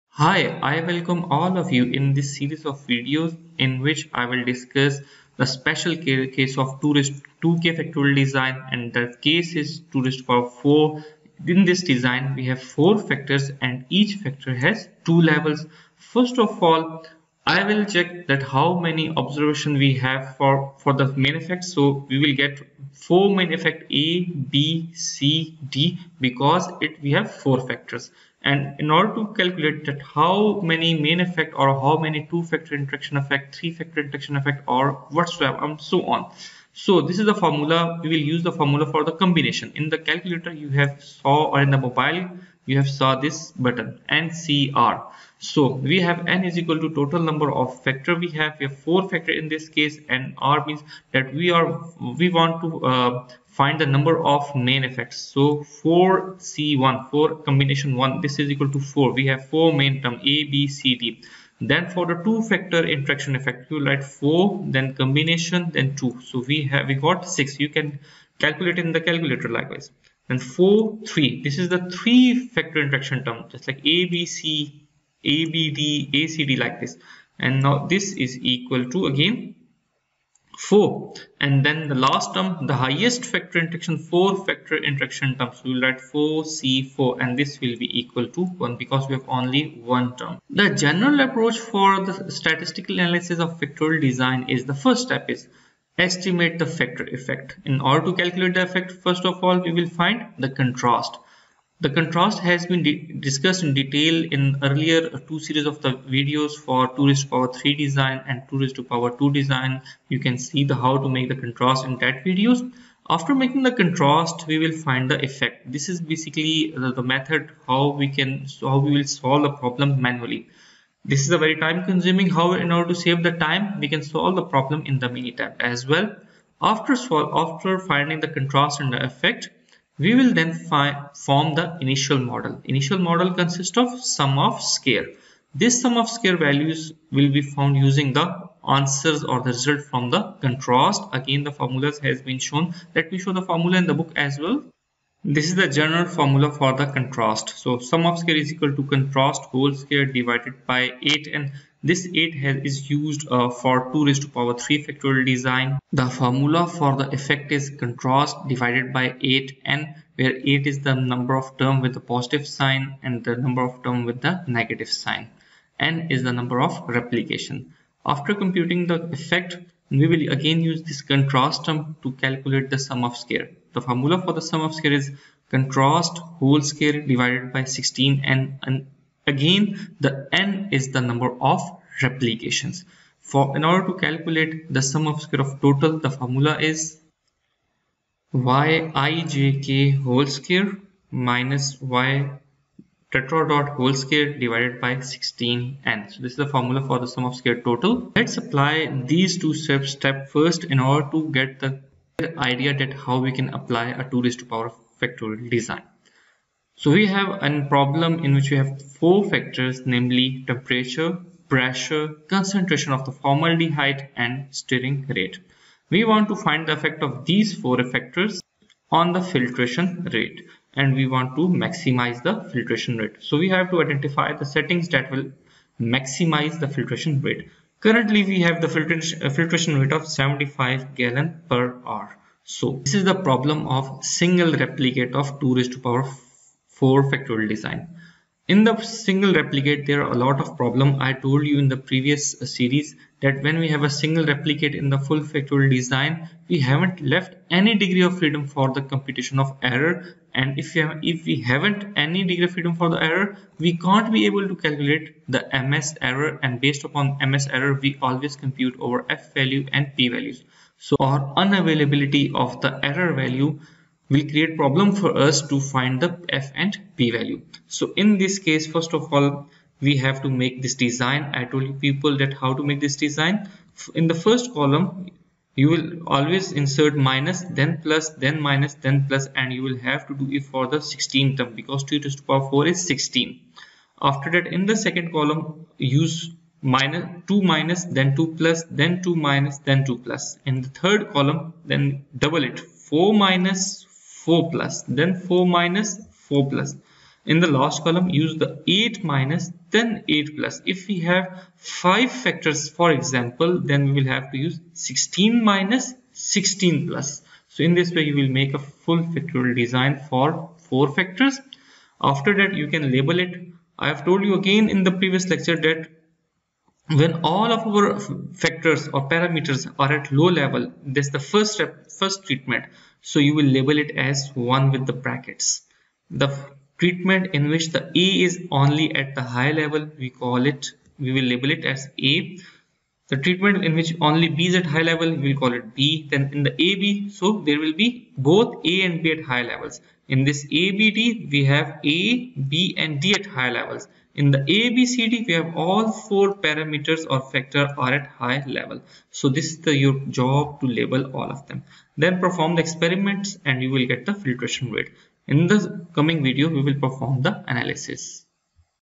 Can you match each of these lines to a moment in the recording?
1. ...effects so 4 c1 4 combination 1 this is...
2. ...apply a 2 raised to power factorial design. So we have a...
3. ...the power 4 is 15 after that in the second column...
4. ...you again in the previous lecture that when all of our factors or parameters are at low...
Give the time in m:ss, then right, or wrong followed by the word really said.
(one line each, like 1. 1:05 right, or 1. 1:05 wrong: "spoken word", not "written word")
1. 0:54 right
2. 3:23 right
3. 4:42 wrong: "16", not "15"
4. 5:14 right.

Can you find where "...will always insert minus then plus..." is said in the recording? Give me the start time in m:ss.
4:35.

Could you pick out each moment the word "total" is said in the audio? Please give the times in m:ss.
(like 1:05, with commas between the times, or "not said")
0:46, 3:05, 3:17.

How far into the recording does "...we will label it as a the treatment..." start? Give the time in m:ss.
5:30.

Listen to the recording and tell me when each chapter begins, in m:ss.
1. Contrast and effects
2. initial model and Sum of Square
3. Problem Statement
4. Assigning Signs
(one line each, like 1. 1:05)
1. 1:41
2. 2:10
3. 3:22
4. 5:15.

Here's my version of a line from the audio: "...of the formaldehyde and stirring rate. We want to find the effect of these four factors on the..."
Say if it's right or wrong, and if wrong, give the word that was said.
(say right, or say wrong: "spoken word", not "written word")
right.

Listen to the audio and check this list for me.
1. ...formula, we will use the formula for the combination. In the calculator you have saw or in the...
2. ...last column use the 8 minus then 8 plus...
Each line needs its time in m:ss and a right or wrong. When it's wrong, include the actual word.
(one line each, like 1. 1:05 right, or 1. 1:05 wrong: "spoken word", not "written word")
1. 0:37 right
2. 4:57 right.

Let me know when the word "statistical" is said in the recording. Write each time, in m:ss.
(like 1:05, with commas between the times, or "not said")
1:32.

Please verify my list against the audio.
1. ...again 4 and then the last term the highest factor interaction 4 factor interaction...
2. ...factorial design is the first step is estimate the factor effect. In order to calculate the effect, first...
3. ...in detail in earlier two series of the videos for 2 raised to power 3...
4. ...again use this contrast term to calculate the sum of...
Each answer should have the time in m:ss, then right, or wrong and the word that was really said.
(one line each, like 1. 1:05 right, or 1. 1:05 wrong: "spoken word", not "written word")
1. 1:19 right
2. 1:33 right
3. 1:43 right
4. 2:50 right.